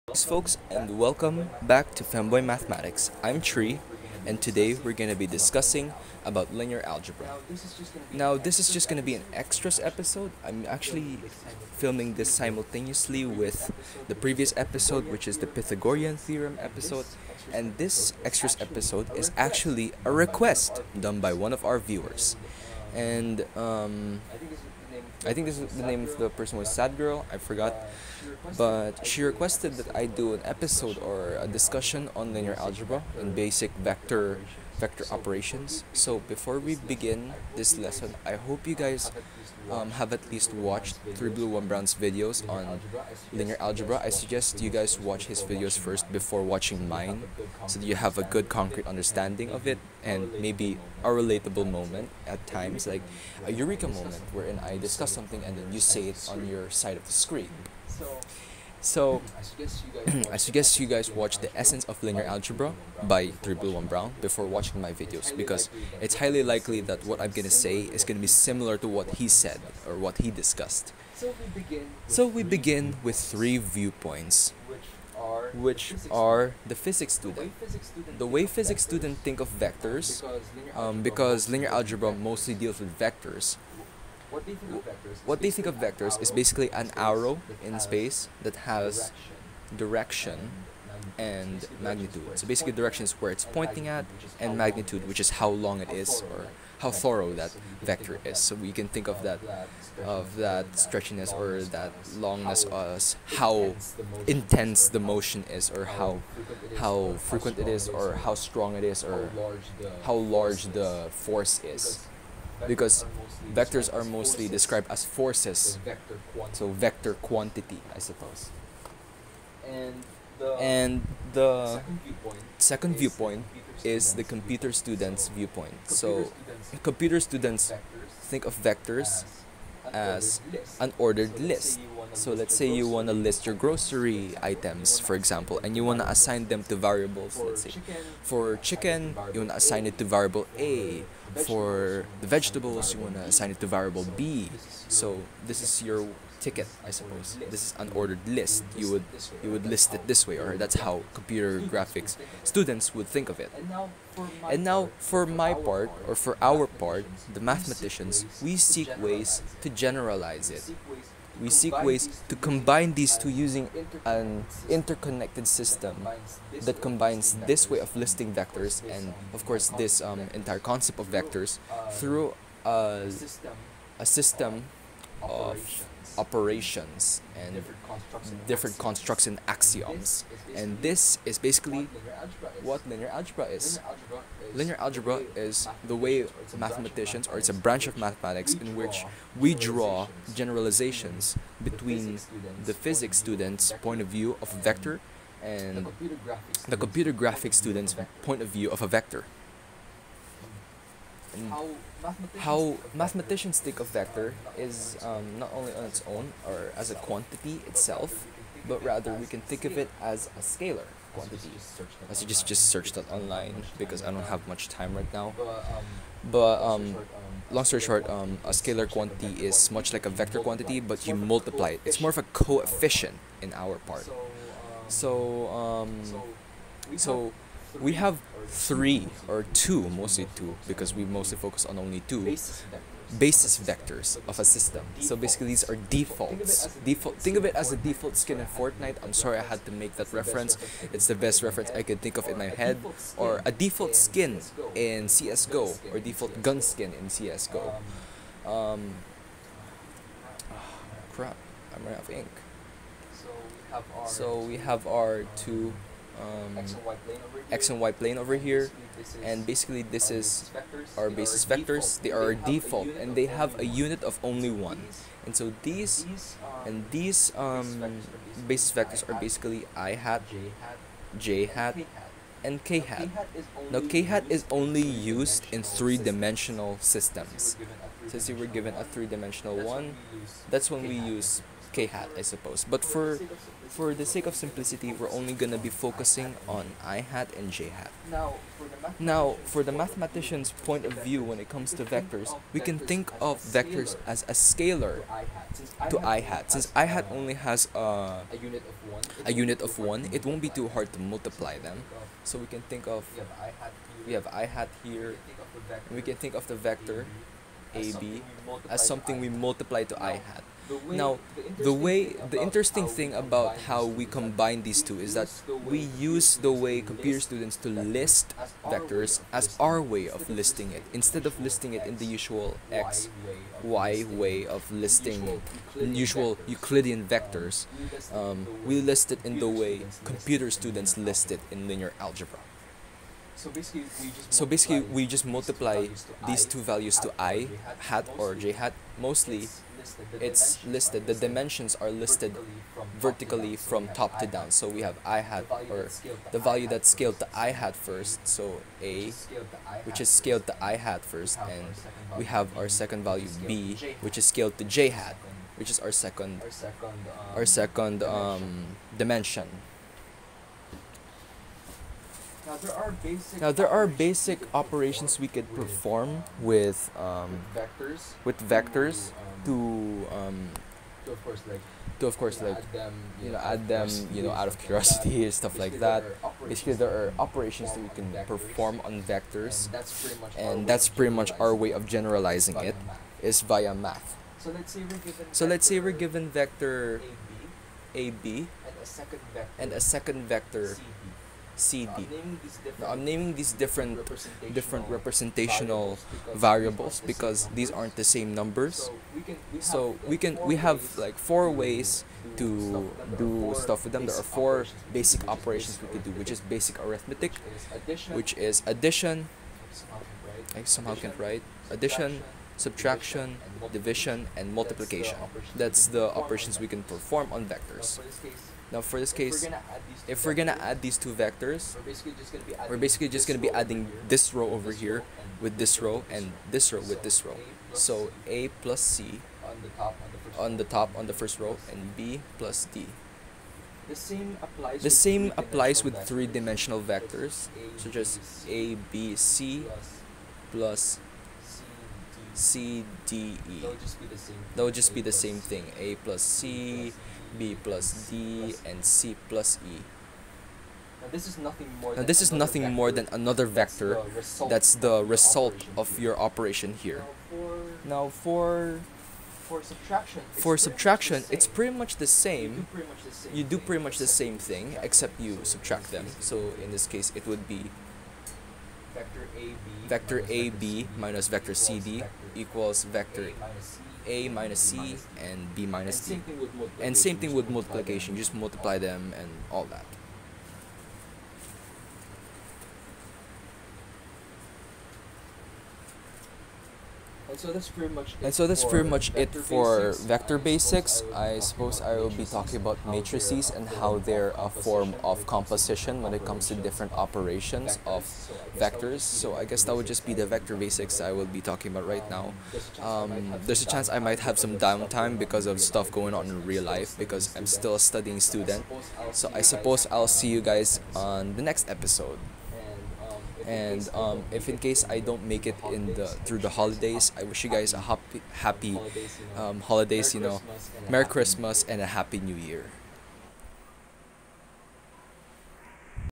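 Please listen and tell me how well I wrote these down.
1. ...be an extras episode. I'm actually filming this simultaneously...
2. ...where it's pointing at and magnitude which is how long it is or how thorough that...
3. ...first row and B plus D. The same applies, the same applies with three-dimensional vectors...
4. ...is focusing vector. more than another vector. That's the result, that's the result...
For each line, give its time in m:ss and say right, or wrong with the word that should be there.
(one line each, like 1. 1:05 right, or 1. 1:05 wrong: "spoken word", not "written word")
1. 0:09 right
2. 1:33 right
3. 7:11 right
4. 7:32 wrong: "nothing", not "focusing".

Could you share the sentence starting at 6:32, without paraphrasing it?
Now, I'm naming these different representational different representational variables because these aren't the same numbers.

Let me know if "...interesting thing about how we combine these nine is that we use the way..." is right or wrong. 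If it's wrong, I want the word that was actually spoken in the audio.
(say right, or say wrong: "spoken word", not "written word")
wrong: "two", not "nine".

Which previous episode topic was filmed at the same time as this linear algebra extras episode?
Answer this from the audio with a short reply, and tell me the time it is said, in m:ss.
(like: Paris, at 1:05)
Pythagorean theorem, at 0:15.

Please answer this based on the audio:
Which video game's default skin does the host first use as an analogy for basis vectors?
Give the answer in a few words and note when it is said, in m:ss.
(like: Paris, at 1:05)
Fortnite, at 3:58.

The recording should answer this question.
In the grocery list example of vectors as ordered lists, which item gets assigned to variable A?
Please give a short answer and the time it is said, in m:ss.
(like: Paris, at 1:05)
Chicken, at 2:18.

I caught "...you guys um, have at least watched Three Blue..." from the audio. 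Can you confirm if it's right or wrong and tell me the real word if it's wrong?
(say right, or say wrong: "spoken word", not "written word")
right.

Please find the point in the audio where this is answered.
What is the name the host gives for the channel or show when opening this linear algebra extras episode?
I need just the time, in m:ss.
0:02.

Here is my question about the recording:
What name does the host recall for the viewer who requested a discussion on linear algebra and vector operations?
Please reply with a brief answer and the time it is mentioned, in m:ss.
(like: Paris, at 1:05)
Sadgirl, at 0:26.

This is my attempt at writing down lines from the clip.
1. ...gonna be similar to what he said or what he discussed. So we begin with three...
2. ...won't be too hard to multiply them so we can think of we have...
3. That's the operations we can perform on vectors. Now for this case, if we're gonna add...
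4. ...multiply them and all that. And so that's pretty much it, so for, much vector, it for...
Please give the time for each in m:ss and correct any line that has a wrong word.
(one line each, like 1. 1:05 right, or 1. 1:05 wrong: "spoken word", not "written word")
1. 1:08 right
2. 5:00 right
3. 6:55 right
4. 7:58 right.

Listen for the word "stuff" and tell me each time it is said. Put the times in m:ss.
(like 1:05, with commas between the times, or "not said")
6:15, 6:43, 8:25.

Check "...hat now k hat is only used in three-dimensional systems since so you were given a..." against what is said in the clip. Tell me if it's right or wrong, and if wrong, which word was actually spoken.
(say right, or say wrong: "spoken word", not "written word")
right.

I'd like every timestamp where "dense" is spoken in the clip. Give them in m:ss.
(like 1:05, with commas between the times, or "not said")
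not said.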